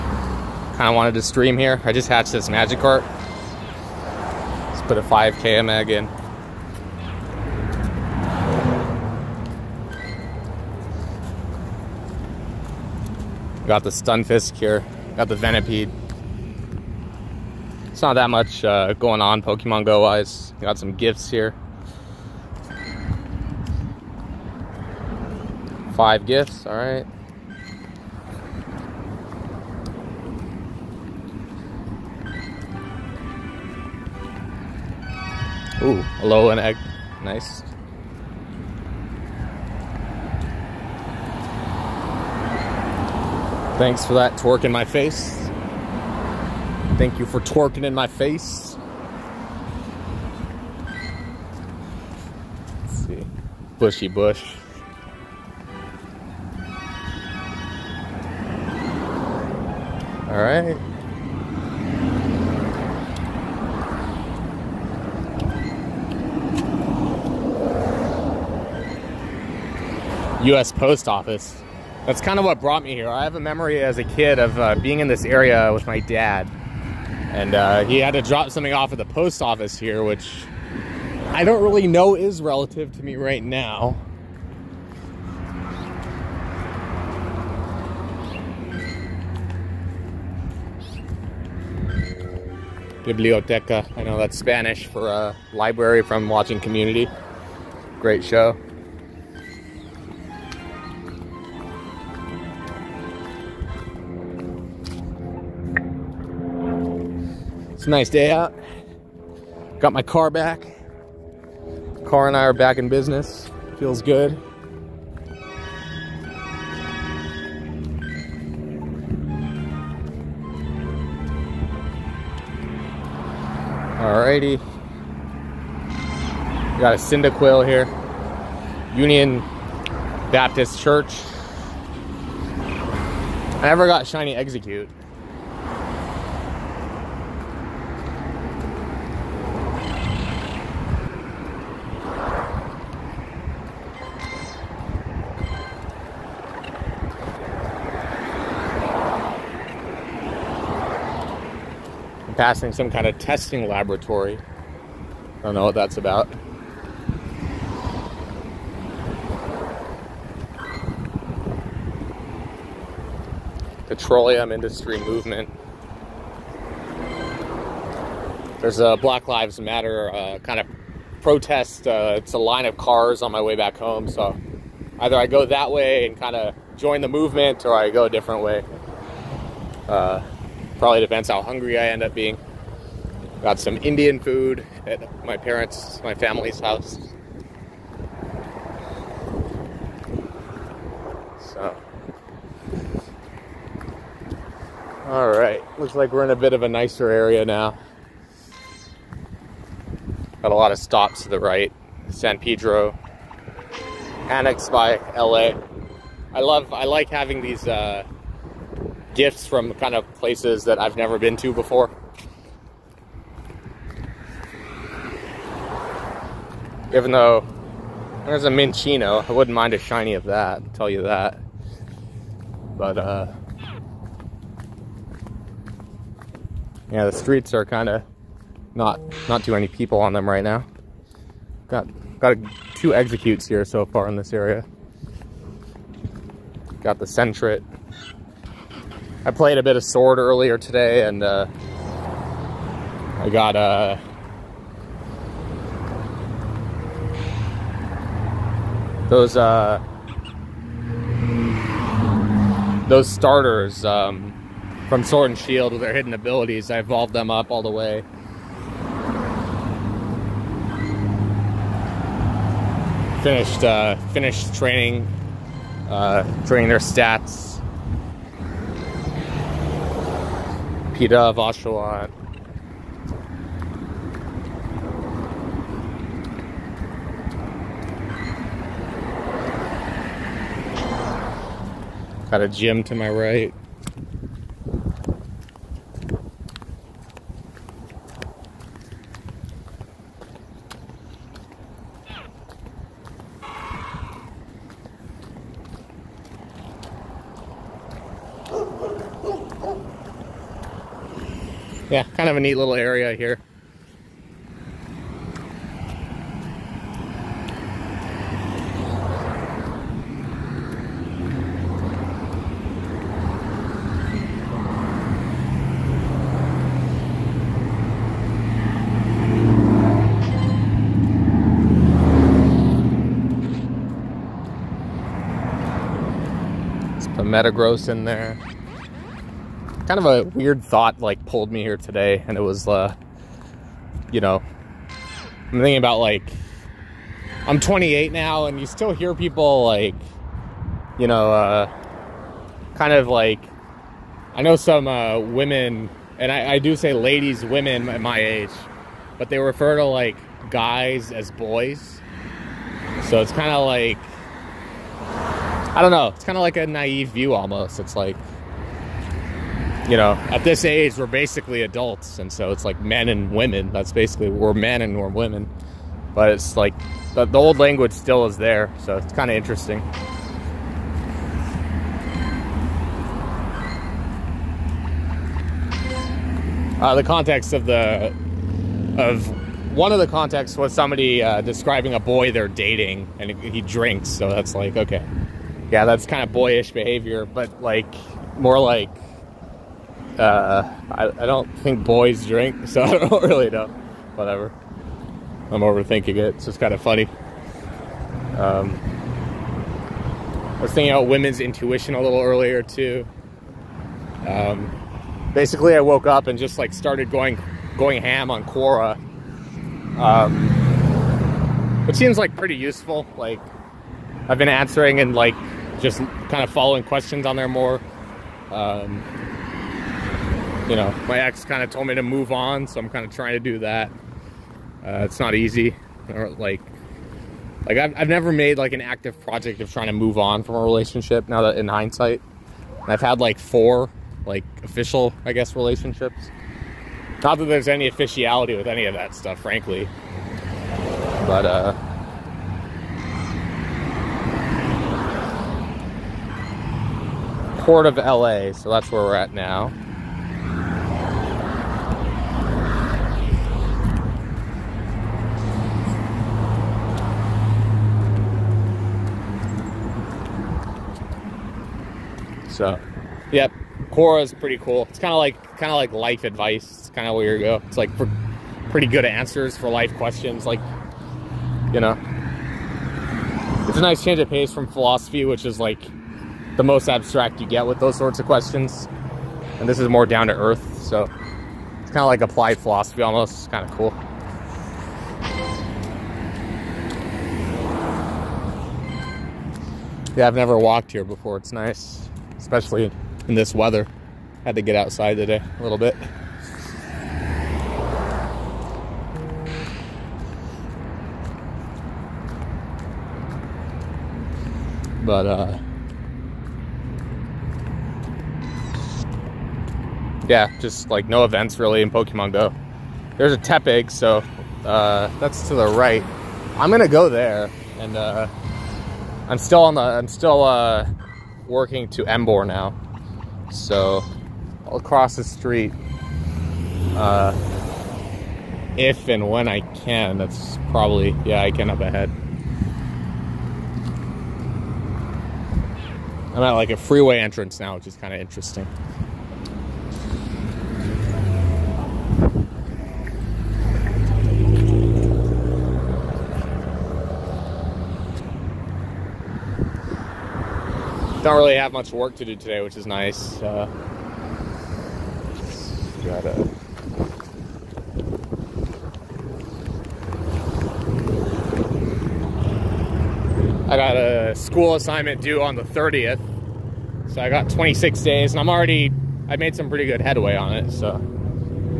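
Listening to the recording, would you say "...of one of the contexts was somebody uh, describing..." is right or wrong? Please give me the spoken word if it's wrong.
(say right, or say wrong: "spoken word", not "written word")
right.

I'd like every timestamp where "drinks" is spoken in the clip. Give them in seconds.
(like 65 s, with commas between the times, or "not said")
383 s, 392 s.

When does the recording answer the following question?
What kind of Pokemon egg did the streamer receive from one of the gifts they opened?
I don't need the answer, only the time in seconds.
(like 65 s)
36 s.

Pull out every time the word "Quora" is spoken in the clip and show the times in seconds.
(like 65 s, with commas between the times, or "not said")
408 s, 463 s.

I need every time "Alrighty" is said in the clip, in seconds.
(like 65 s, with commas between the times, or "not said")
124 s.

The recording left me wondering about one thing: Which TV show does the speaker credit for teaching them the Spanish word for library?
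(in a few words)
Community.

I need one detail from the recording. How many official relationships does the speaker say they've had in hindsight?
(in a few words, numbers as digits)
4.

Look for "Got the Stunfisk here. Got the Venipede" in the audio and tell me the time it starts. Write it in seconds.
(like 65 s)
13 s.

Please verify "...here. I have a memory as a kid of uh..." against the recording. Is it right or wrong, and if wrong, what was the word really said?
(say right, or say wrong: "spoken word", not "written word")
right.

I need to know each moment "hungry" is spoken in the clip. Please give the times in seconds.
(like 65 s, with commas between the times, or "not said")
181 s.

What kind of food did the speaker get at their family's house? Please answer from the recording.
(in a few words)
Indian food.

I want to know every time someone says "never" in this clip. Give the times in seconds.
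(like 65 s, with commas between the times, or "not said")
133 s, 210 s, 428 s, 490 s.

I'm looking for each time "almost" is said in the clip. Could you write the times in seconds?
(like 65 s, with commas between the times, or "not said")
357 s, 483 s.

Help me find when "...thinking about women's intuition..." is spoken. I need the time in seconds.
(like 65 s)
400 s.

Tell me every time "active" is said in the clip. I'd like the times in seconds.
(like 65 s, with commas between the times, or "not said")
428 s.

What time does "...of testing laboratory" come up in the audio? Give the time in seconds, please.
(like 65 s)
153 s.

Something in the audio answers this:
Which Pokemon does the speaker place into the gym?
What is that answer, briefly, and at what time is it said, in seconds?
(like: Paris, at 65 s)
Metagross, at 327 s.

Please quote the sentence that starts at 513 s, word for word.
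There's a Tepig, so uh, that's to the right.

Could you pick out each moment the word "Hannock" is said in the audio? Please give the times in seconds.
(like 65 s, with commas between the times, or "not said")
not said.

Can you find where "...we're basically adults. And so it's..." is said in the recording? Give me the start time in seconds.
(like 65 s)
360 s.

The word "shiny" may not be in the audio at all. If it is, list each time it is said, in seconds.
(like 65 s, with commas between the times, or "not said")
134 s, 219 s.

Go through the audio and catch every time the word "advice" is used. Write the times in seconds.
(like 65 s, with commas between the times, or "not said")
466 s.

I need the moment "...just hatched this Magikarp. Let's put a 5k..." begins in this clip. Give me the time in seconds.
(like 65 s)
1 s.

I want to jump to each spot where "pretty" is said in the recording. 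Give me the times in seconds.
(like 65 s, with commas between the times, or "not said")
412 s, 464 s, 468 s, 569 s.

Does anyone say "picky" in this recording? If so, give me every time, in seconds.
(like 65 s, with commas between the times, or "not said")
not said.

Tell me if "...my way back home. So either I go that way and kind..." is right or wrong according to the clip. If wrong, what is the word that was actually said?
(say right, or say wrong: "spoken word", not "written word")
right.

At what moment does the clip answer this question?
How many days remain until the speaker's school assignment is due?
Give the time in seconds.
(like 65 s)
567 s.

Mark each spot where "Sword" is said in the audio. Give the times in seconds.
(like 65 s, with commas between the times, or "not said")
239 s, 255 s.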